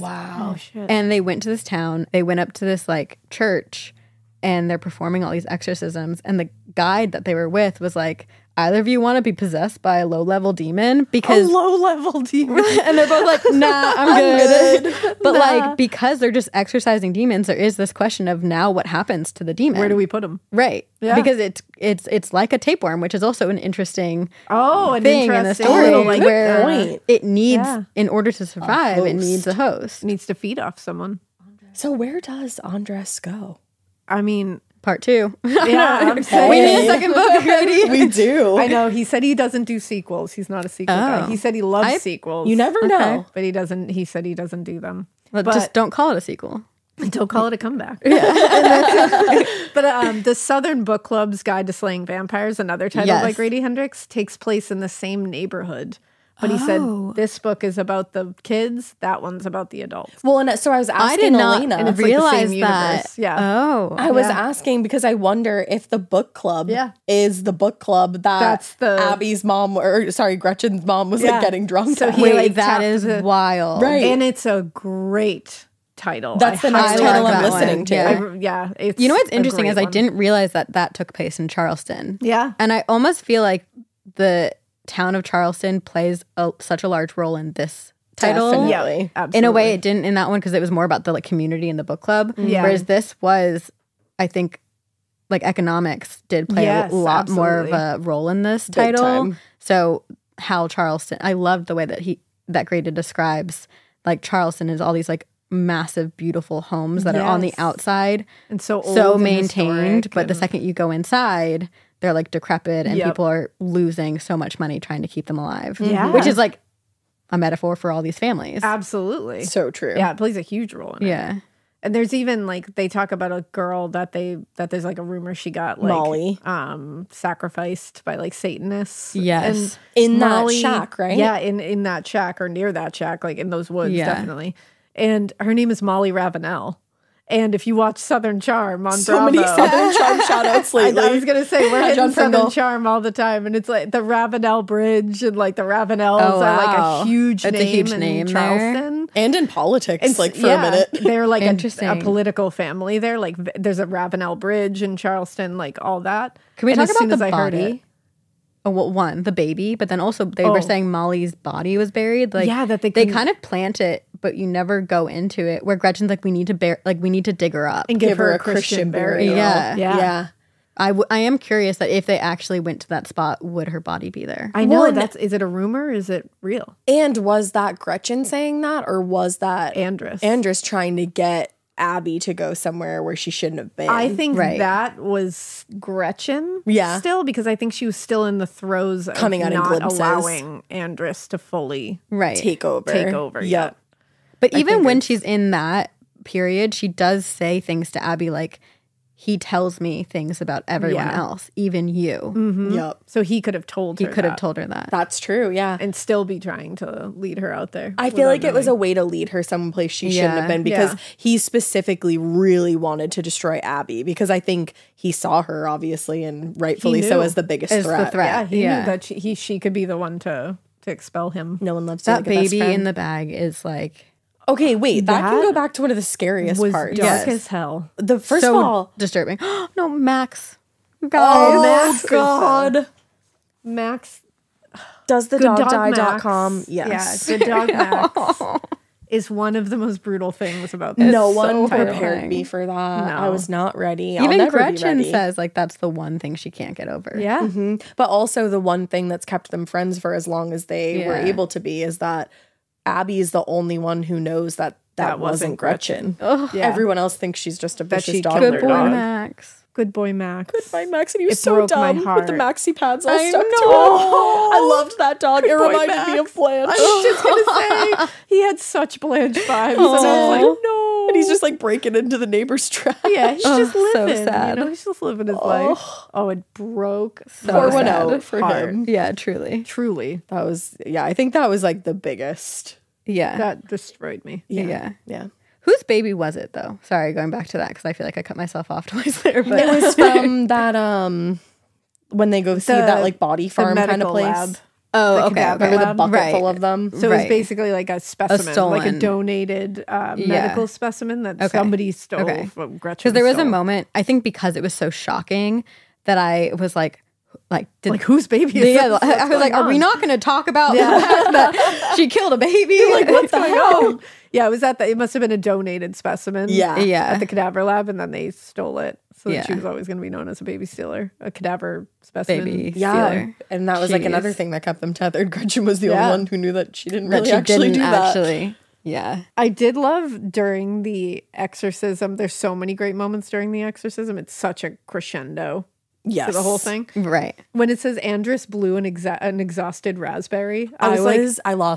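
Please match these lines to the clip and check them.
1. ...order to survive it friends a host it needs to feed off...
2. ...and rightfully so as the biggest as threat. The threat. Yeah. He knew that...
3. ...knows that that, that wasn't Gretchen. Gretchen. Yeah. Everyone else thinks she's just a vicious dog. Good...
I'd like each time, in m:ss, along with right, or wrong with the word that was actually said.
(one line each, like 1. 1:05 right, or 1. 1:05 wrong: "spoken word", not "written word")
1. 0:28 wrong: "needs", not "friends"
2. 3:36 right
3. 4:14 right.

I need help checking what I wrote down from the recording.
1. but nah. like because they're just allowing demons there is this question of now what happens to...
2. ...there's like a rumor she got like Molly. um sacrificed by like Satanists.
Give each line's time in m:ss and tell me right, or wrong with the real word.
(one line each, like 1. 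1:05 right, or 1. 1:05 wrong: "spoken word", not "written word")
1. 0:15 wrong: "exercising", not "allowing"
2. 2:04 right.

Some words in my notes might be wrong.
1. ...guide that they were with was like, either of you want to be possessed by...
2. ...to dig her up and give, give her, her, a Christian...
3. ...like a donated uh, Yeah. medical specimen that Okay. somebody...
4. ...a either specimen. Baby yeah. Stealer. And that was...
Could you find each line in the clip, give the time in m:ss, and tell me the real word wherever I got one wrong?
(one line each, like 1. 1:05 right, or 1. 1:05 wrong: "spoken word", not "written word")
1. 0:06 right
2. 2:47 right
3. 4:58 right
4. 5:21 wrong: "cadaver", not "either".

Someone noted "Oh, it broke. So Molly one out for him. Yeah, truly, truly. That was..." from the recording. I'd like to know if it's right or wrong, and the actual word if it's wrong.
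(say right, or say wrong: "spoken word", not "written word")
wrong: "Poor", not "Molly".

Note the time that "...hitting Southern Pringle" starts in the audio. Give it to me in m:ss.
2:21.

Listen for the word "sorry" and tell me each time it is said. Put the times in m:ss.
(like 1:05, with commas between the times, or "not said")
1:10, 4:46.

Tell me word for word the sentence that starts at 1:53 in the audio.
people are losing so much money trying to keep them alive.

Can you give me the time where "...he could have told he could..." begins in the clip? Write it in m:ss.
3:23.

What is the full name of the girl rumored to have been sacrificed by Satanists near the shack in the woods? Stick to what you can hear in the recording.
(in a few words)
Molly Ravenel.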